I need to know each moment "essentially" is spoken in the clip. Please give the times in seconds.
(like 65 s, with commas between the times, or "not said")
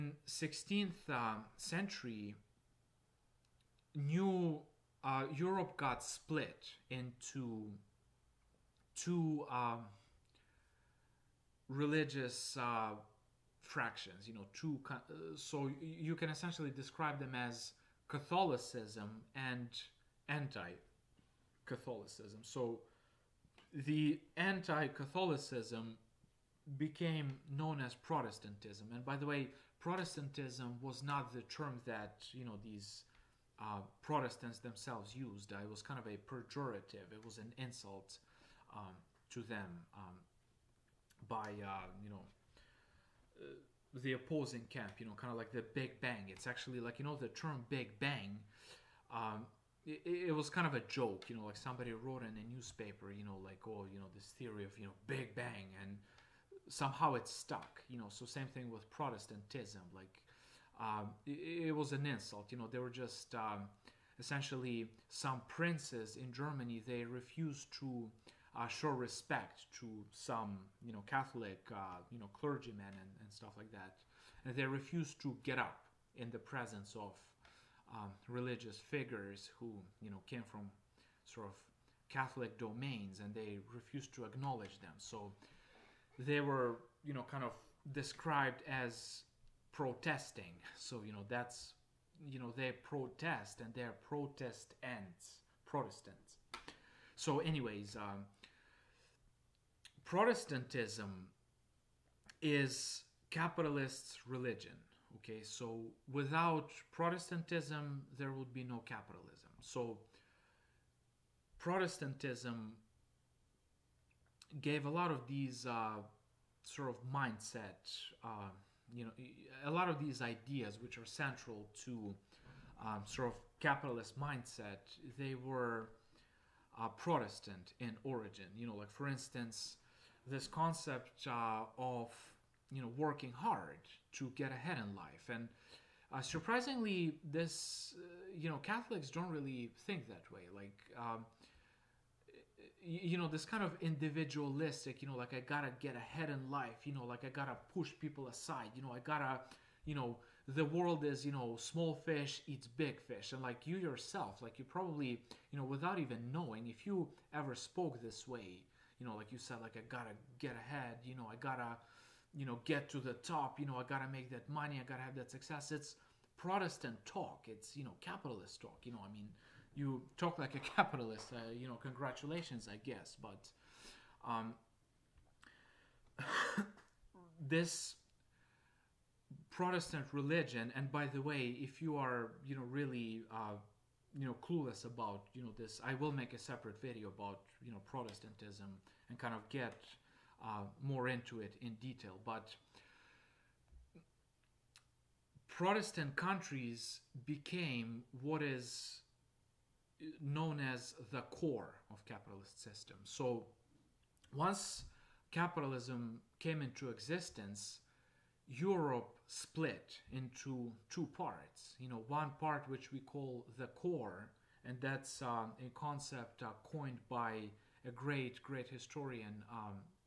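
16 s, 64 s.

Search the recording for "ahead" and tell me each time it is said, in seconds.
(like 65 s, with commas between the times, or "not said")
134 s, 145 s, 160 s.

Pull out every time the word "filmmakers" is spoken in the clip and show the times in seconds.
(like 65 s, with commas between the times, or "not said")
not said.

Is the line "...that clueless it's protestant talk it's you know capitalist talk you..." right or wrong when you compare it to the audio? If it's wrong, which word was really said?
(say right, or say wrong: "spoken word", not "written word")
wrong: "success", not "clueless".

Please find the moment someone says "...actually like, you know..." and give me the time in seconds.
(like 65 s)
46 s.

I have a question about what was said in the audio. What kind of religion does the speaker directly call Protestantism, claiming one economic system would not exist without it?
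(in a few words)
capitalist religion.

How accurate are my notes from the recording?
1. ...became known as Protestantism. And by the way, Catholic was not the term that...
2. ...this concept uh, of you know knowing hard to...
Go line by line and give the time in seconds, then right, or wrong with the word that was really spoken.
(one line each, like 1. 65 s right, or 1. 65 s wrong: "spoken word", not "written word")
1. 26 s wrong: "Protestantism", not "Catholic"
2. 130 s wrong: "working", not "knowing".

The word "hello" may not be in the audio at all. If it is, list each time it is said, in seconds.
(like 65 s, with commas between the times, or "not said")
not said.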